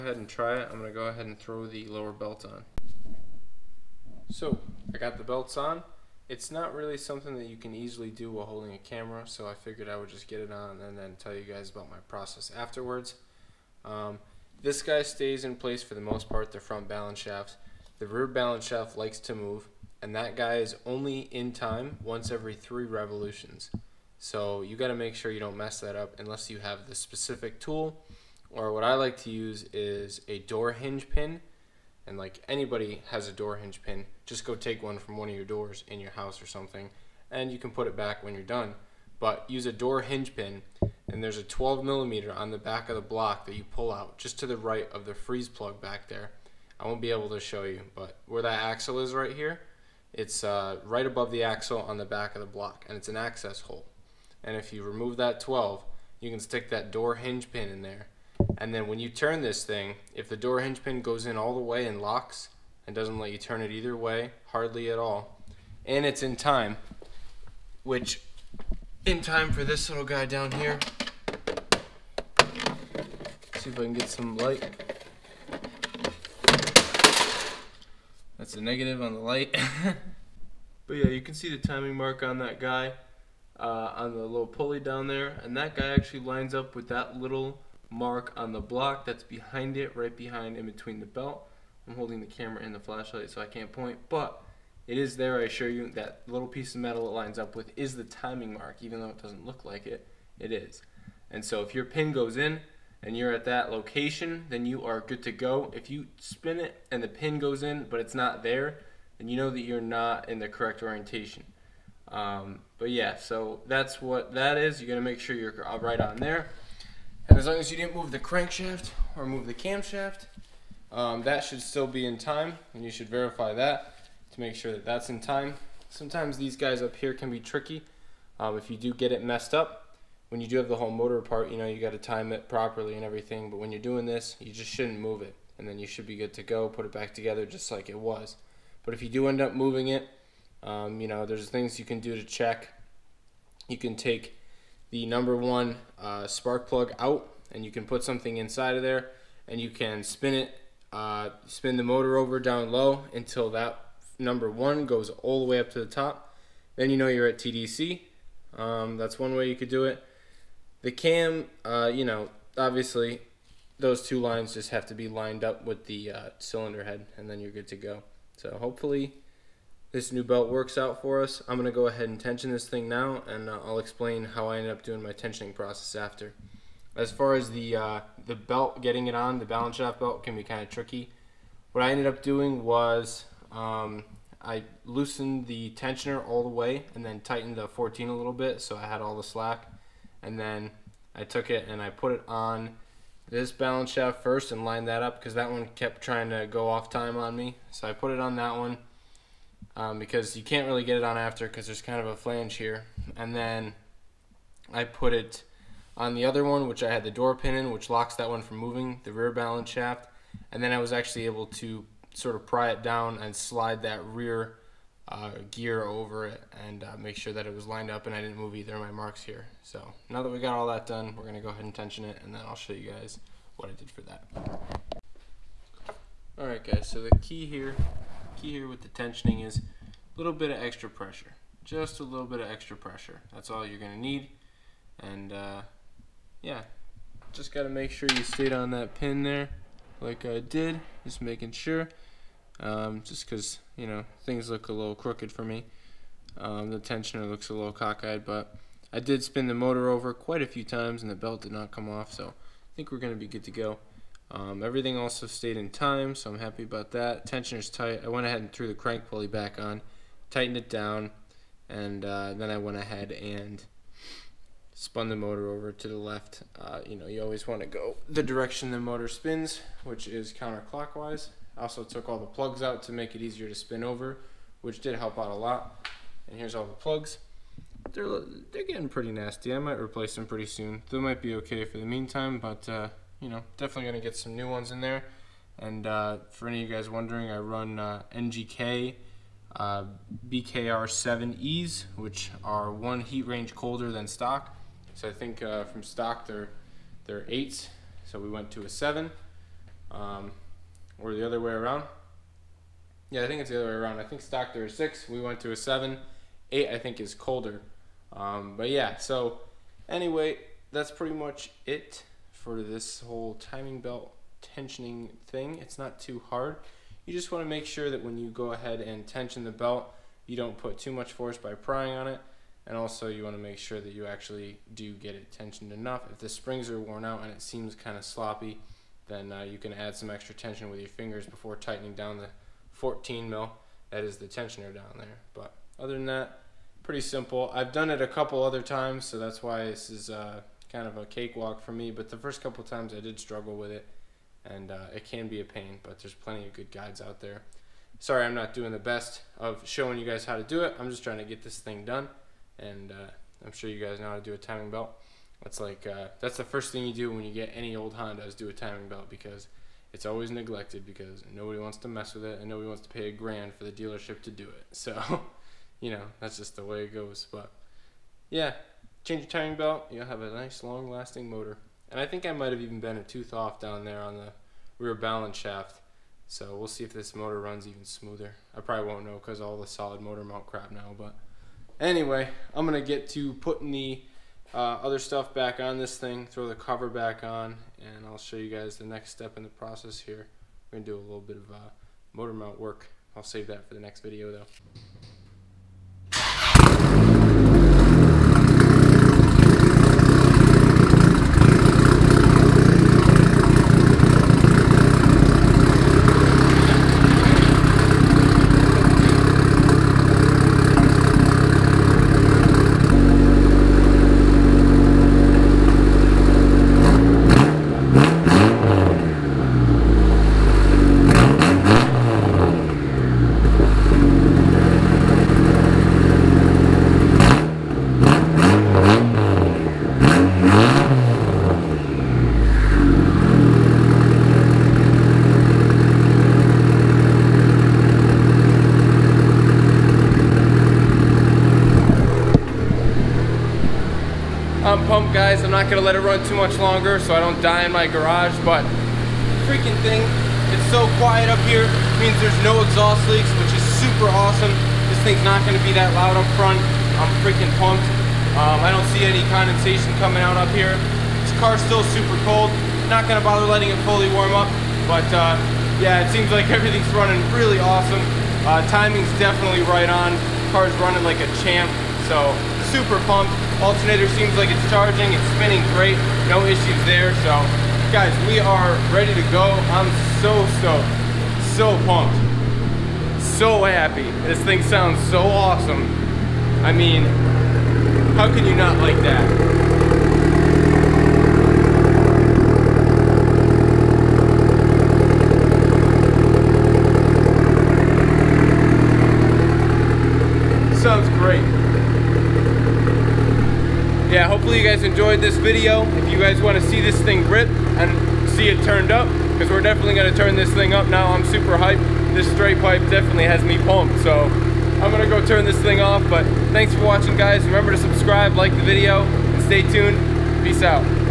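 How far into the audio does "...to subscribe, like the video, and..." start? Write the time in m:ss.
8:37.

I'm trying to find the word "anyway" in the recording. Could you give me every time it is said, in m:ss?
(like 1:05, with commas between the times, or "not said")
5:09, 6:21.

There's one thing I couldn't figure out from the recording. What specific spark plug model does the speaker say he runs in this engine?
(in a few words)
NGK BKR7E.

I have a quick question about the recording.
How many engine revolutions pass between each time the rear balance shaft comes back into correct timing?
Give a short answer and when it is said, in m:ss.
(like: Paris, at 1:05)
3, at 0:22.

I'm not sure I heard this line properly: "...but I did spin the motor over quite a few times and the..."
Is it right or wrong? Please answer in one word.
right.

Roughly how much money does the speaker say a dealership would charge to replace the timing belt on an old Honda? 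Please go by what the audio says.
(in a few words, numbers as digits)
a grand.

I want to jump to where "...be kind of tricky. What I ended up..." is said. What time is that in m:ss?
3:00.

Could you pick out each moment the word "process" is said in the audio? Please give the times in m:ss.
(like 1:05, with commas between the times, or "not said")
0:12, 2:55, 6:29.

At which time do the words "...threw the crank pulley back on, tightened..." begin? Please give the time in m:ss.
4:18.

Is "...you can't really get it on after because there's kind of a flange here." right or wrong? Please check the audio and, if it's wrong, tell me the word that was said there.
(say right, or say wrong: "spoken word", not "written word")
right.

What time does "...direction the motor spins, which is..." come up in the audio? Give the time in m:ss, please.
4:28.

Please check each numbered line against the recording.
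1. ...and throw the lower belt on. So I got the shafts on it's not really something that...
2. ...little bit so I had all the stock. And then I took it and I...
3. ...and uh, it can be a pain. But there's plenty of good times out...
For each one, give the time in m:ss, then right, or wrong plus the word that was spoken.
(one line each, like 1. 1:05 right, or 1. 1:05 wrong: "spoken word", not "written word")
1. 0:01 wrong: "belts", not "shafts"
2. 3:08 wrong: "slack", not "stock"
3. 5:44 wrong: "guides", not "times".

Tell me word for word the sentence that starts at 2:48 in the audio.
So hopefully this new belt works out for us.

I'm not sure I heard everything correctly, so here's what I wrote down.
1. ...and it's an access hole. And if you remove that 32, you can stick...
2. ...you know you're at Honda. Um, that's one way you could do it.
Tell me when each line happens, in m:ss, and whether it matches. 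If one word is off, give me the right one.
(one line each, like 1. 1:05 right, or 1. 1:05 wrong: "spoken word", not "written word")
1. 0:52 wrong: "12", not "32"
2. 2:36 wrong: "TDC", not "Honda".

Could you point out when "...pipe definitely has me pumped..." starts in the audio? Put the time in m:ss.
8:32.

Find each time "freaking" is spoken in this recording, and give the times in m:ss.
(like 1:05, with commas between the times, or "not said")
7:29, 7:37.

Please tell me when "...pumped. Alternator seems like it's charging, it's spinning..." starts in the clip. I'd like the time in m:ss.
7:53.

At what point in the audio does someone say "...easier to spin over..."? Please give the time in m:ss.
4:33.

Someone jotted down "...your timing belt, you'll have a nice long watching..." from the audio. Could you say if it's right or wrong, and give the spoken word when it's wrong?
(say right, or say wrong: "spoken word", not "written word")
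wrong: "lasting", not "watching".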